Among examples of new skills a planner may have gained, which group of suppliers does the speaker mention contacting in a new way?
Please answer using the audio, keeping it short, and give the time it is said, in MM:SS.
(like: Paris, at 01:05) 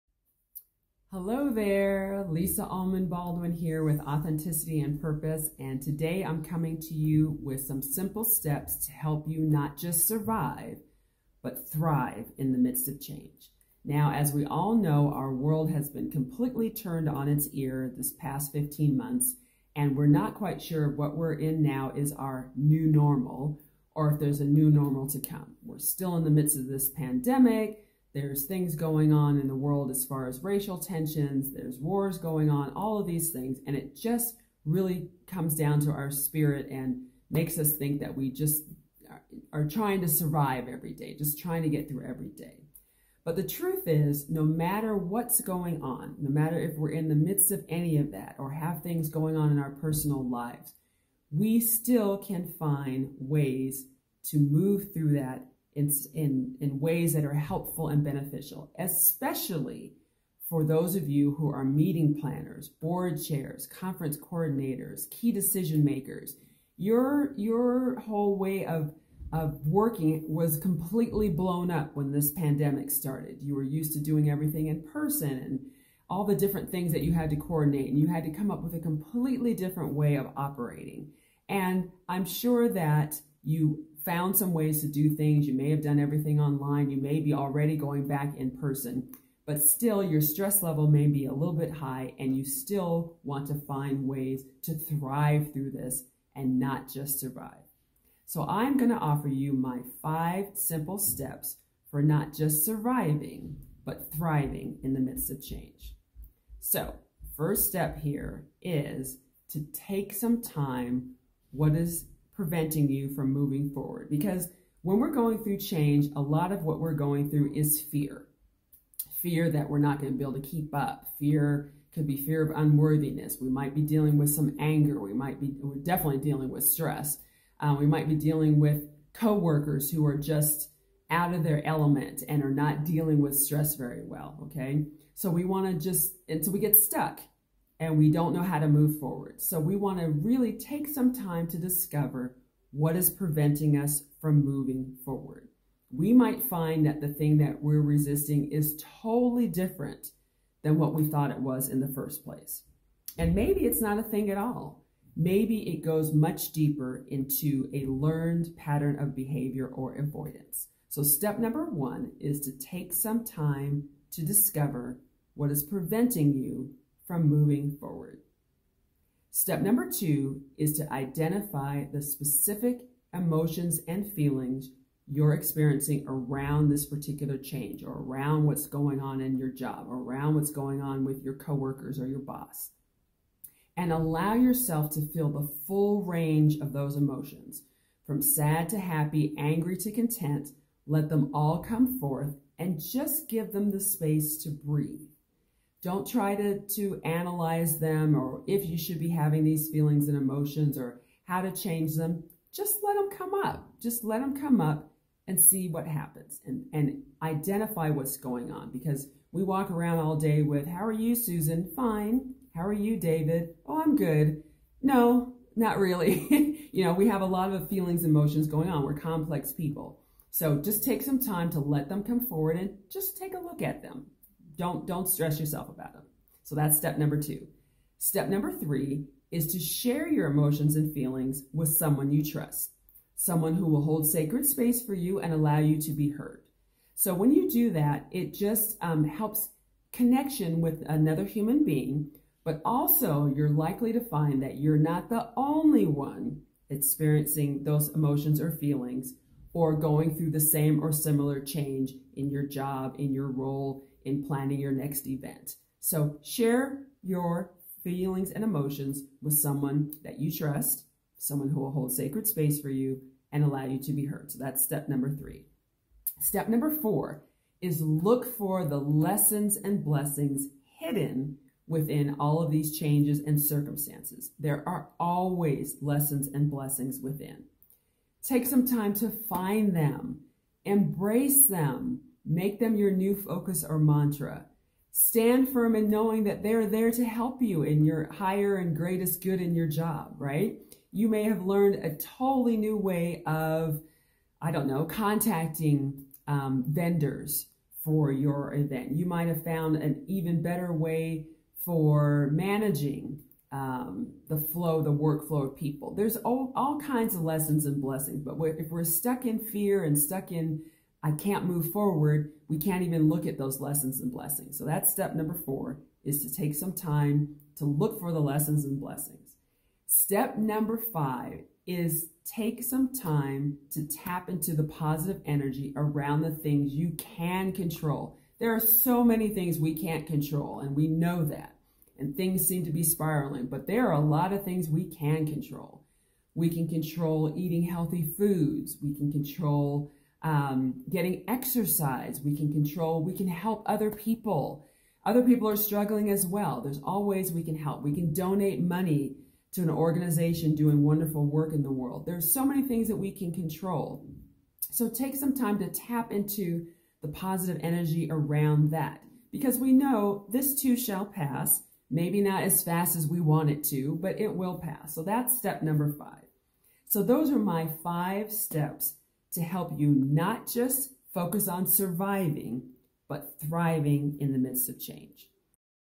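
Vendors, at 04:56.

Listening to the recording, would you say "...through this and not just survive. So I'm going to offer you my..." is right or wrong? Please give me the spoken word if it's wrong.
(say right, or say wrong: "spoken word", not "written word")
right.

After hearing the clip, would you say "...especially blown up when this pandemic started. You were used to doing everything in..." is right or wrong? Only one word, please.
wrong.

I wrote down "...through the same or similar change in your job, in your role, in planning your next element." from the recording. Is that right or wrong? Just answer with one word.
wrong.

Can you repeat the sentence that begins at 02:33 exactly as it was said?
And maybe it's not a thing at all.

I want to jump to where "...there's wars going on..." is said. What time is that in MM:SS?
00:31.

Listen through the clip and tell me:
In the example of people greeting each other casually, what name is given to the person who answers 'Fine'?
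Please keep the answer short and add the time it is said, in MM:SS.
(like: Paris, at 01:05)
Susan, at 03:31.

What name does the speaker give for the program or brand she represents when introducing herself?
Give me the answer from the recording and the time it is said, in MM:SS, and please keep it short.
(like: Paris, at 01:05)
Authenticity and Purpose, at 00:04.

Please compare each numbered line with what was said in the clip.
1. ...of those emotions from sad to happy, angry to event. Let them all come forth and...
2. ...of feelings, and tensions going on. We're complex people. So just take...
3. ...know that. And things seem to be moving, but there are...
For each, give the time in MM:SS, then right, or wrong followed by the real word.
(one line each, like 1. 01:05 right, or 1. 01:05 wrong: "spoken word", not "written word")
1. 03:06 wrong: "content", not "event"
2. 03:37 wrong: "emotions", not "tensions"
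3. 05:30 wrong: "spiraling", not "moving".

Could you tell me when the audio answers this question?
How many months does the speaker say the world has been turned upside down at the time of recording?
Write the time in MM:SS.
00:18.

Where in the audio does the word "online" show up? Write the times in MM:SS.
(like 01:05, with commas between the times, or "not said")
01:26.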